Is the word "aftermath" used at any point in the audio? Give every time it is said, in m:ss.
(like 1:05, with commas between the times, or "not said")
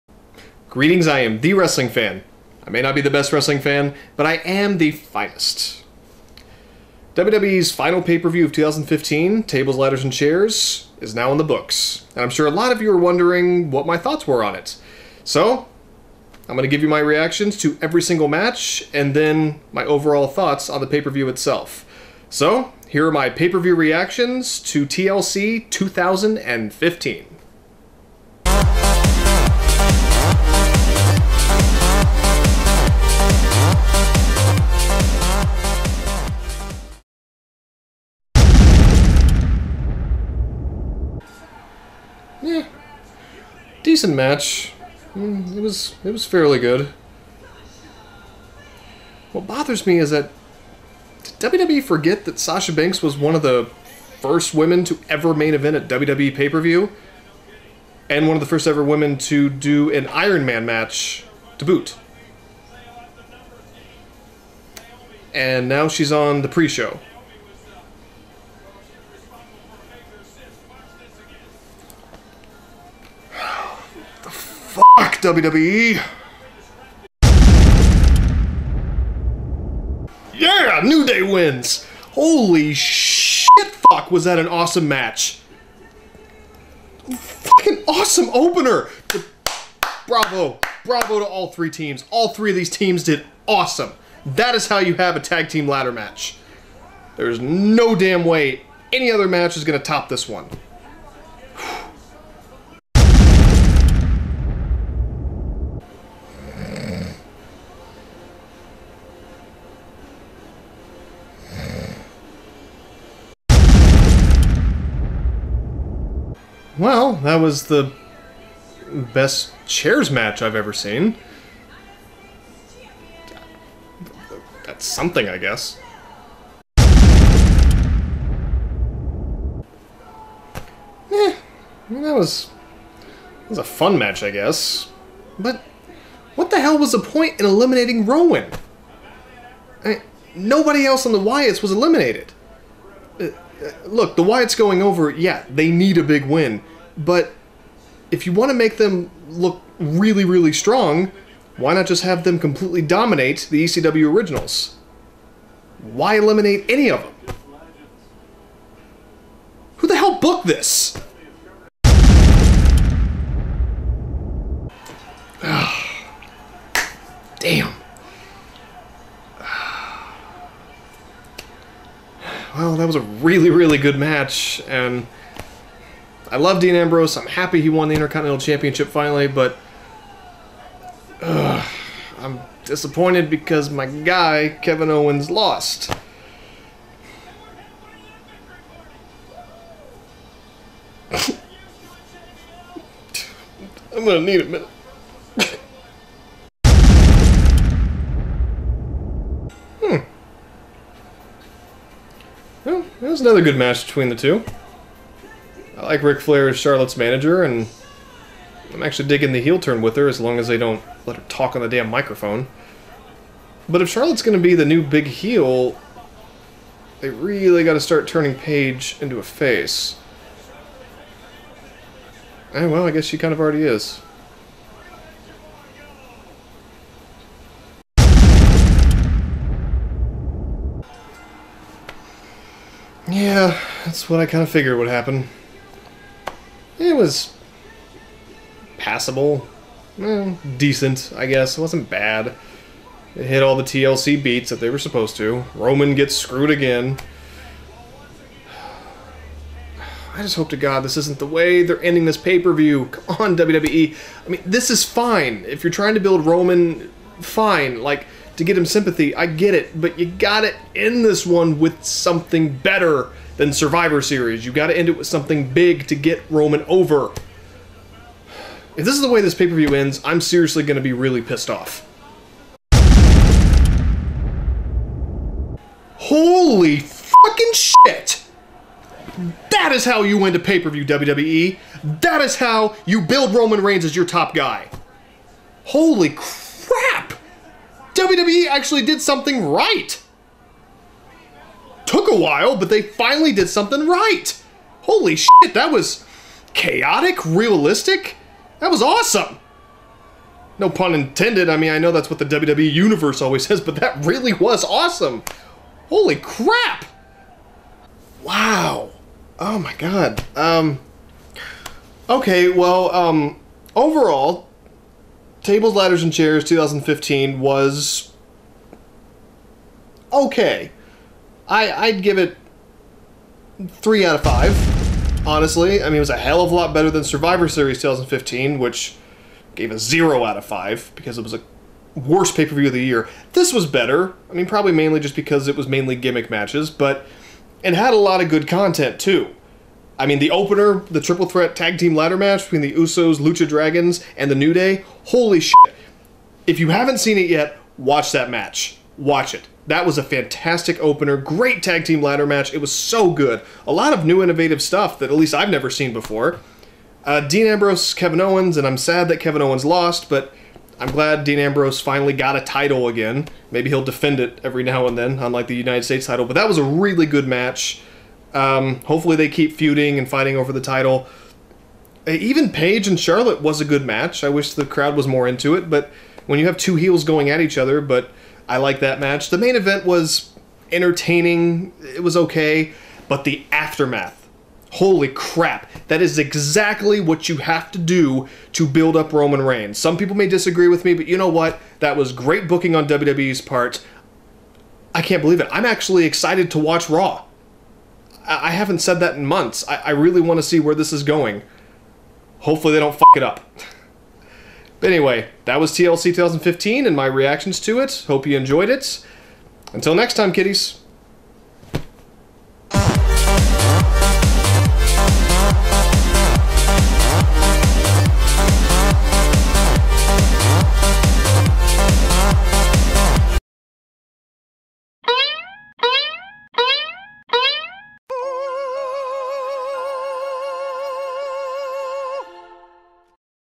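6:23.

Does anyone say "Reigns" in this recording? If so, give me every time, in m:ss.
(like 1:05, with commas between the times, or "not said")
4:43, 6:29.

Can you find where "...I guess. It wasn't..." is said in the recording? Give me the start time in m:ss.
4:01.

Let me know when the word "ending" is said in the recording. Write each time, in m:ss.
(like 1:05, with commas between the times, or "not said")
4:11.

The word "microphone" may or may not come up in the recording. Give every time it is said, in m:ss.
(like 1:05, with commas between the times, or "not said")
3:31.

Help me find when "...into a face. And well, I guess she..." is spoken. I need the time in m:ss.
3:39.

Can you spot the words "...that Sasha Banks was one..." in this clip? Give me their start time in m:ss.
0:52.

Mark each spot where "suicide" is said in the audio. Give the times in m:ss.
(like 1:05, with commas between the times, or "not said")
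not said.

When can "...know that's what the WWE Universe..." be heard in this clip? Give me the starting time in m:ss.
5:01.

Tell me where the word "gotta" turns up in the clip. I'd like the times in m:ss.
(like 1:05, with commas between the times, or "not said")
4:20, 4:24.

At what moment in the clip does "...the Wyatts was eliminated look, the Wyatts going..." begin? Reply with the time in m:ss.
2:21.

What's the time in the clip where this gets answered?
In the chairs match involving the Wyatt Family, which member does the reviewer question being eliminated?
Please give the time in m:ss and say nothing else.
2:18.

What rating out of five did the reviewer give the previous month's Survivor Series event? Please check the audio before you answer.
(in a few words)
0.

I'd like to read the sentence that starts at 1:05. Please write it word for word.
And now she's on the pre show.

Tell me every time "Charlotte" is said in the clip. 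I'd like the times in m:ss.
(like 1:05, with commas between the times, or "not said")
3:26, 3:33, 6:12.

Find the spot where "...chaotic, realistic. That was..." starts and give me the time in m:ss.
4:56.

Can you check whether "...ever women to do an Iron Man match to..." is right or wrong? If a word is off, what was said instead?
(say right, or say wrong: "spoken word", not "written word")
right.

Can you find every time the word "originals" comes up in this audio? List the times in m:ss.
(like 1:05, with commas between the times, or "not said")
2:34.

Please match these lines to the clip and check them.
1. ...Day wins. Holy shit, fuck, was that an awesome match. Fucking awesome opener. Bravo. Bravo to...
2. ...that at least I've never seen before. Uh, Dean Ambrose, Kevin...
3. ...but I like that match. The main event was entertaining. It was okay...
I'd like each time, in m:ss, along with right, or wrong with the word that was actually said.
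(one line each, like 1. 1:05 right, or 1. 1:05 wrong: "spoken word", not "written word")
1. 1:21 right
2. 5:54 right
3. 6:17 right.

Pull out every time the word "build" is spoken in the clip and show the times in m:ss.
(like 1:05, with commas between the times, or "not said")
4:15, 4:43, 6:28.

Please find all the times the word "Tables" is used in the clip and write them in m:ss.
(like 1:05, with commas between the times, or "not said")
0:09, 5:15.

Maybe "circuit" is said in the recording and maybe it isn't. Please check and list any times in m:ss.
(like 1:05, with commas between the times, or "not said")
not said.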